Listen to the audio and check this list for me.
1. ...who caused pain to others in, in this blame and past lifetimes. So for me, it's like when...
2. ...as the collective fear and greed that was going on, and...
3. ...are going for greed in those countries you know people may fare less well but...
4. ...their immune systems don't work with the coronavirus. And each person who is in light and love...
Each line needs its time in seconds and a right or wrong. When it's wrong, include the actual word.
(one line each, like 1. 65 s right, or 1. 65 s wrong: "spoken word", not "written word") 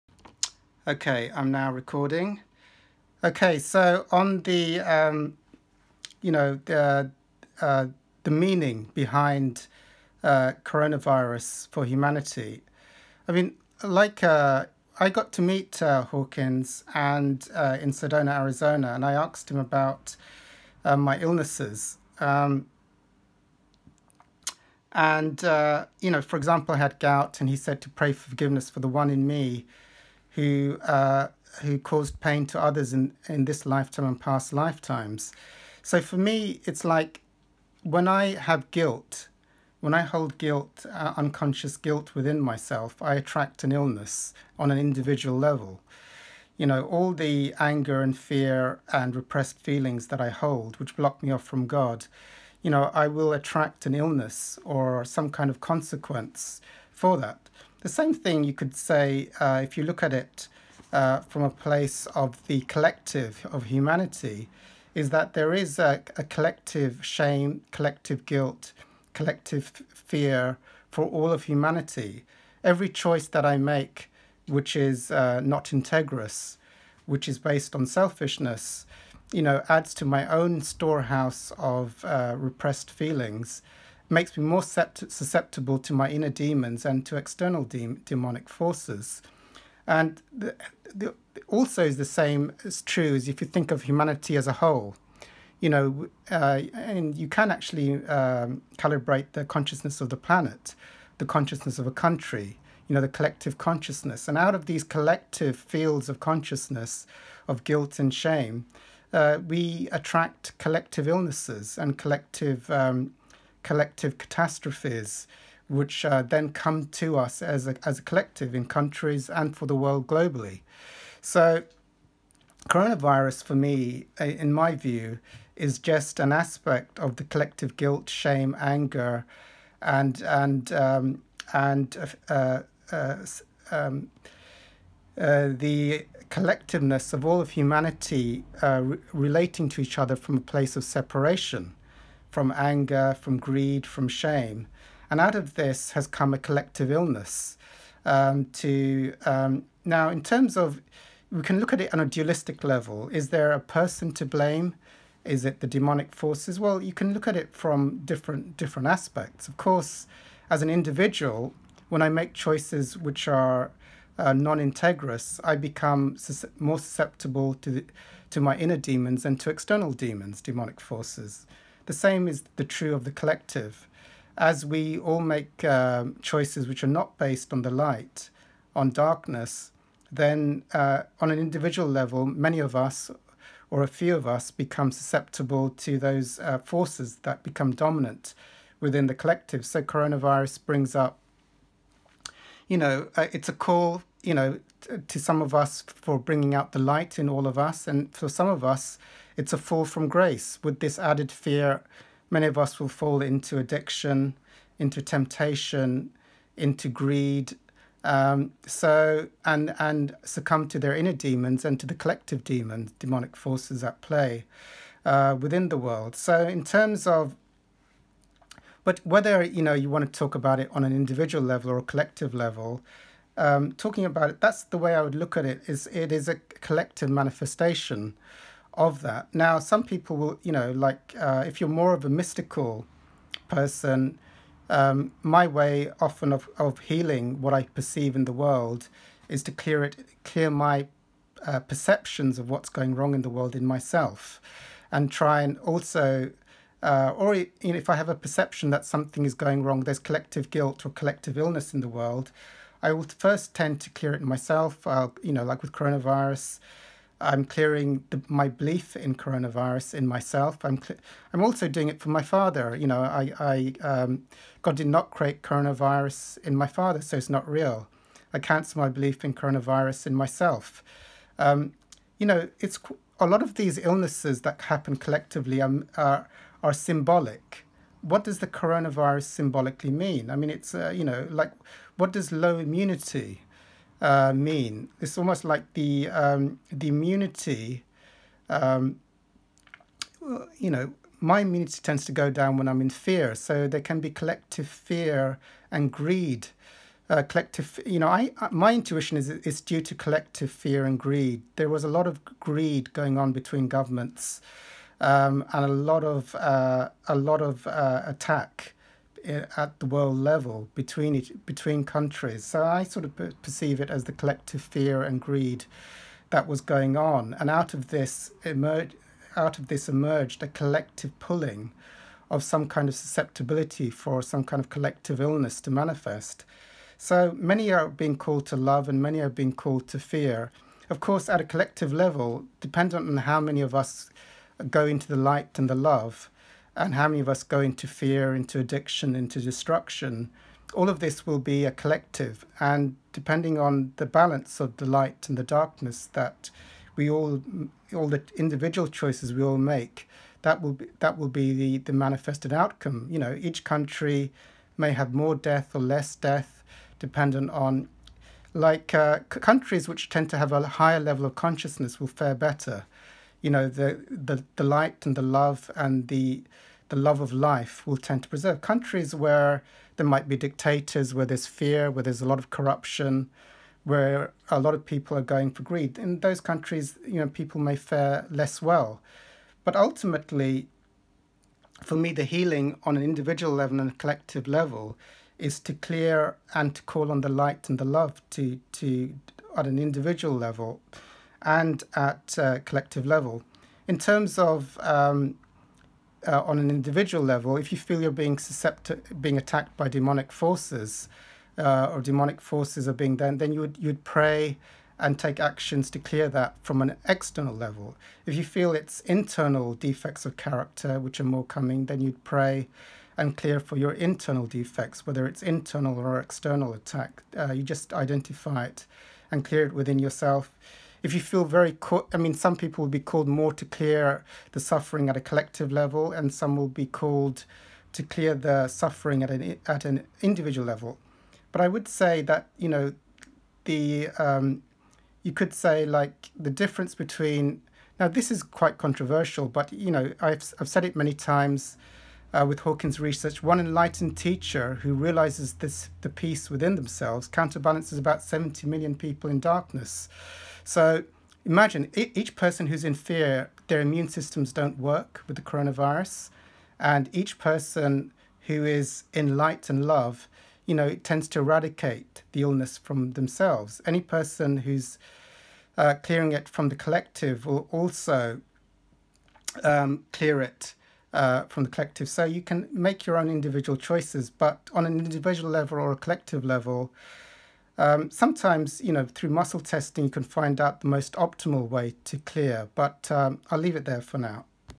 1. 31 s wrong: "lifetime", not "blame"
2. 313 s right
3. 375 s right
4. 453 s right.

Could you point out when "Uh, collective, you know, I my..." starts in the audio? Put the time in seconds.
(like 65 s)
297 s.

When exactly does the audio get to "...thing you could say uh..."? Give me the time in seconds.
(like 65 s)
58 s.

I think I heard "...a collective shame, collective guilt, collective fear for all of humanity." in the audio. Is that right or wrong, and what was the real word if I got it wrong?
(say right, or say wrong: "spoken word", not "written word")
right.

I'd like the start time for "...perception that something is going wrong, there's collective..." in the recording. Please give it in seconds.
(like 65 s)
248 s.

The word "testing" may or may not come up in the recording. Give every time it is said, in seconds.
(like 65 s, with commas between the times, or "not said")
479 s.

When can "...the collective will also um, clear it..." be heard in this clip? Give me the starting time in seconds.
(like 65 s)
466 s.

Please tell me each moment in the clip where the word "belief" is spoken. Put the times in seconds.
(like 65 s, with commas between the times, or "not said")
258 s, 268 s.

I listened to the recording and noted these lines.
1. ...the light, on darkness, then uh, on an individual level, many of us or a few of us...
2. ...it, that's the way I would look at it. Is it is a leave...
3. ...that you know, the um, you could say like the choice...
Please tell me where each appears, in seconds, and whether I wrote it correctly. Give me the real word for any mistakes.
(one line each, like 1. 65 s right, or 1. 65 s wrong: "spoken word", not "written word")
1. 177 s right
2. 224 s wrong: "collective", not "leave"
3. 432 s wrong: "difference", not "choice".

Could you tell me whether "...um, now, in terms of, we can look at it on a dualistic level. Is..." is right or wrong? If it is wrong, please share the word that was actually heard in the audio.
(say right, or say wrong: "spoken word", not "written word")
right.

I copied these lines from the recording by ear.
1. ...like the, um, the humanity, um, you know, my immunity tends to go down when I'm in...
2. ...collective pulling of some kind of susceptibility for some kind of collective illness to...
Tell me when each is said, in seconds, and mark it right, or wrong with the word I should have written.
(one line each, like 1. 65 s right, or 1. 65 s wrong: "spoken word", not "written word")
1. 285 s wrong: "immunity", not "humanity"
2. 320 s right.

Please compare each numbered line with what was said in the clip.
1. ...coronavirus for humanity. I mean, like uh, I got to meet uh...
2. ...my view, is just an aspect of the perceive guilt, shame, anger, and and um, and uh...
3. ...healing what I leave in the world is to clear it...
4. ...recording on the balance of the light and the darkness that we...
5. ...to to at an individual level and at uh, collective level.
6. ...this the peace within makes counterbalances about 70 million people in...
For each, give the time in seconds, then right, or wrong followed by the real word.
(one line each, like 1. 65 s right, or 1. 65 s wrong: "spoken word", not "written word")
1. 10 s right
2. 124 s wrong: "collective", not "perceive"
3. 236 s wrong: "perceive", not "leave"
4. 343 s wrong: "depending", not "recording"
5. 388 s right
6. 445 s wrong: "themselves", not "makes".